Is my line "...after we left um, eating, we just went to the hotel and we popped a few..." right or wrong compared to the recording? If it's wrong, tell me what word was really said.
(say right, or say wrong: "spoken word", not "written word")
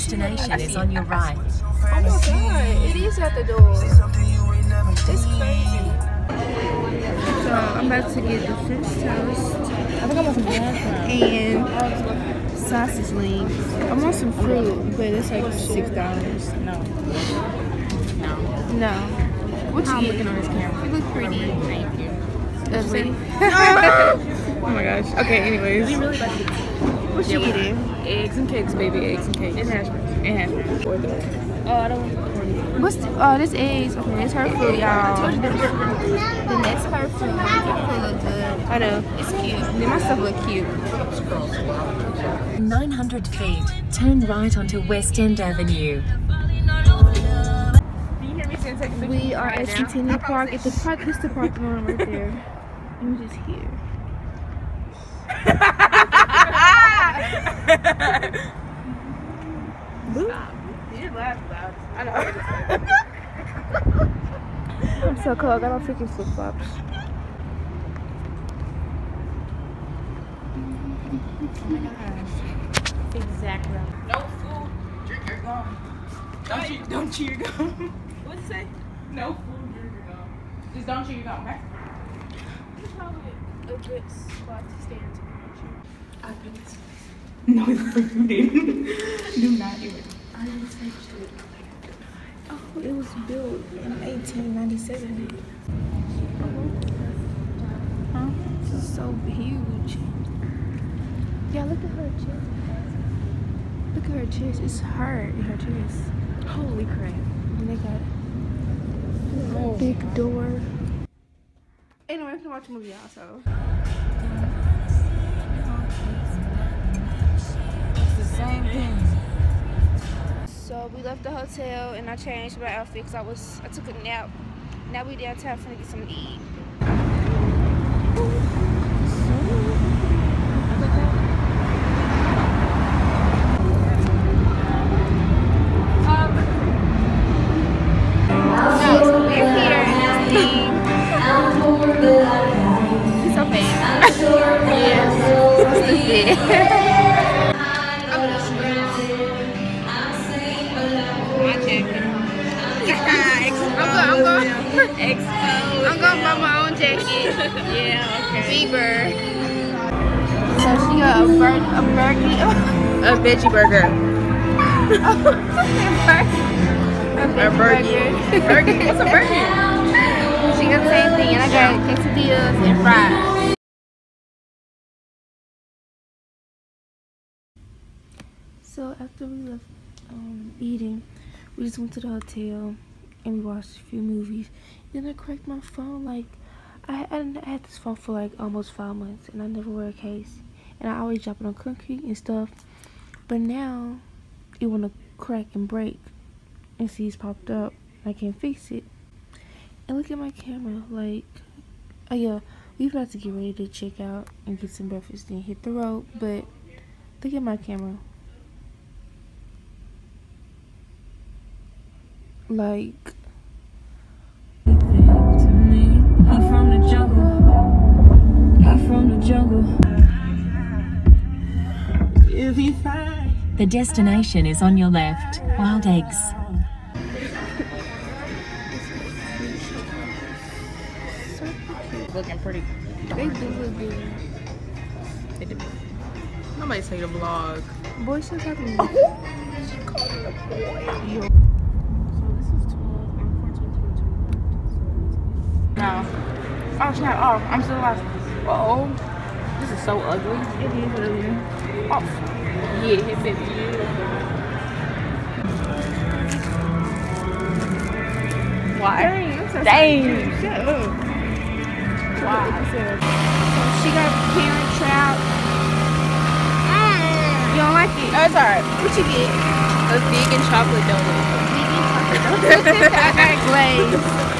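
wrong: "watched", not "popped".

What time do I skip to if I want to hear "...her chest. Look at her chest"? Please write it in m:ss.
1:41.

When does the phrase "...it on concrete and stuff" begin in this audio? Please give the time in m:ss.
3:11.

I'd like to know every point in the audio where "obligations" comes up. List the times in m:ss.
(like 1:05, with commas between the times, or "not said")
not said.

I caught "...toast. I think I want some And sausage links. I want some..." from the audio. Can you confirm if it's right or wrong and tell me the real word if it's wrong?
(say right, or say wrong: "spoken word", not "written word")
right.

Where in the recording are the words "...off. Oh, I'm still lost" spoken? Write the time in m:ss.
4:07.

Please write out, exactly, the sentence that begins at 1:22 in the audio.
It's probably a good spot to stand to I picked.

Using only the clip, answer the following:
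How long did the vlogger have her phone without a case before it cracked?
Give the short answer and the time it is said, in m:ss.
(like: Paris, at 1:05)
almost five months, at 3:08.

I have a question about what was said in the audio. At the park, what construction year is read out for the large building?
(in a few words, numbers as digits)
1897.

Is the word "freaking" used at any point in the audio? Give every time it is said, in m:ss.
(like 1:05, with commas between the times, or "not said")
1:05.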